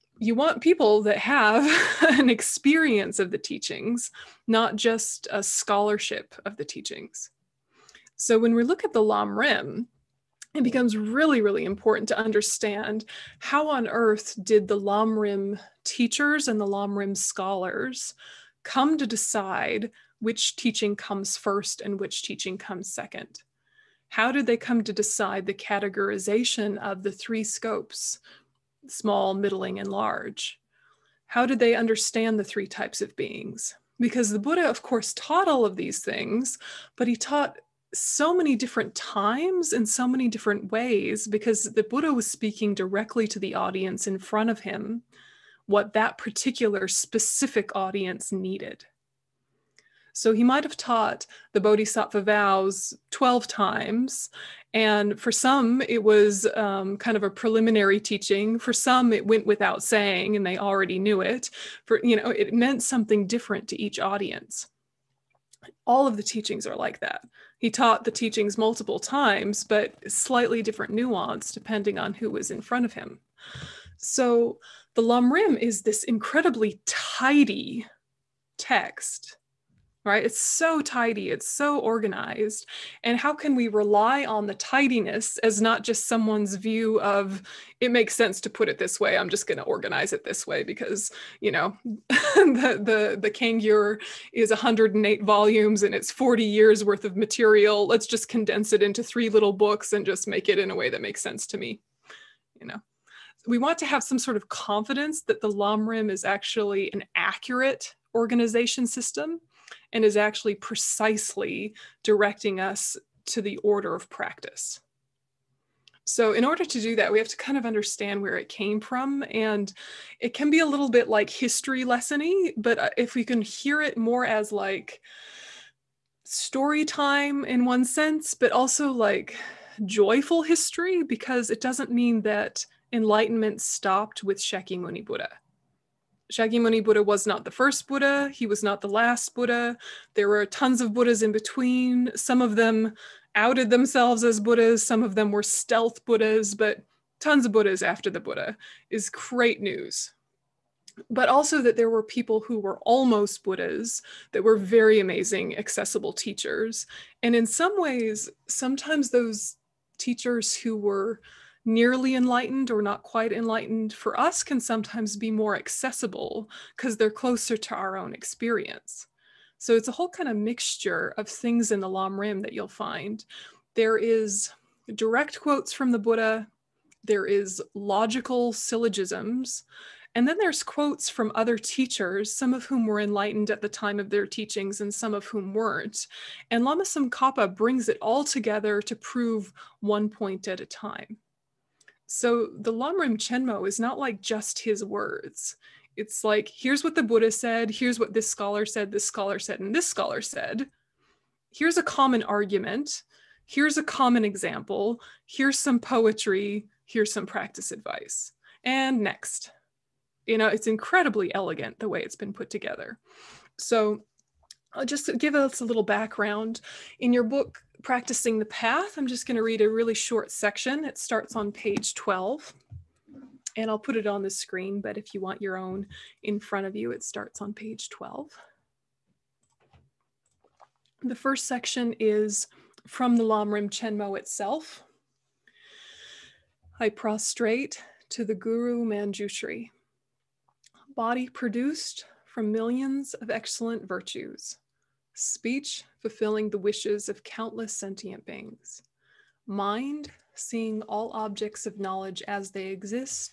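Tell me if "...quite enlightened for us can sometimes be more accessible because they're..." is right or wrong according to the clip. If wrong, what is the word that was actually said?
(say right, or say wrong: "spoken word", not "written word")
right.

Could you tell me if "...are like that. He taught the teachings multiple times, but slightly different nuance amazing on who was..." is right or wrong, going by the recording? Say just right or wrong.
wrong.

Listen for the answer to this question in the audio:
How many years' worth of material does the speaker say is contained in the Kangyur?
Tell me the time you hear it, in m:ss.
1:36.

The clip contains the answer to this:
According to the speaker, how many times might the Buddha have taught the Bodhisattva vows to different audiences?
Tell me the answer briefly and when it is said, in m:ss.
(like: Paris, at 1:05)
12, at 0:53.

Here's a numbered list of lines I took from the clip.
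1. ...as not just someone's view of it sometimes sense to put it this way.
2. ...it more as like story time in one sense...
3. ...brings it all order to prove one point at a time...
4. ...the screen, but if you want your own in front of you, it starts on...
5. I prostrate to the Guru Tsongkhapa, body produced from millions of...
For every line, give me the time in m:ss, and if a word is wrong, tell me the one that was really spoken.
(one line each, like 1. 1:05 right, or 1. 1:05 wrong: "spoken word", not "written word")
1. 1:25 wrong: "makes", not "sometimes"
2. 2:03 right
3. 3:07 wrong: "together", not "order"
4. 3:44 right
5. 3:56 wrong: "Manjushri", not "Tsongkhapa".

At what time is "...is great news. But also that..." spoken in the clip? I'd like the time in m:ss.
2:28.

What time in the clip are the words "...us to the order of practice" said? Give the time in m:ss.
1:52.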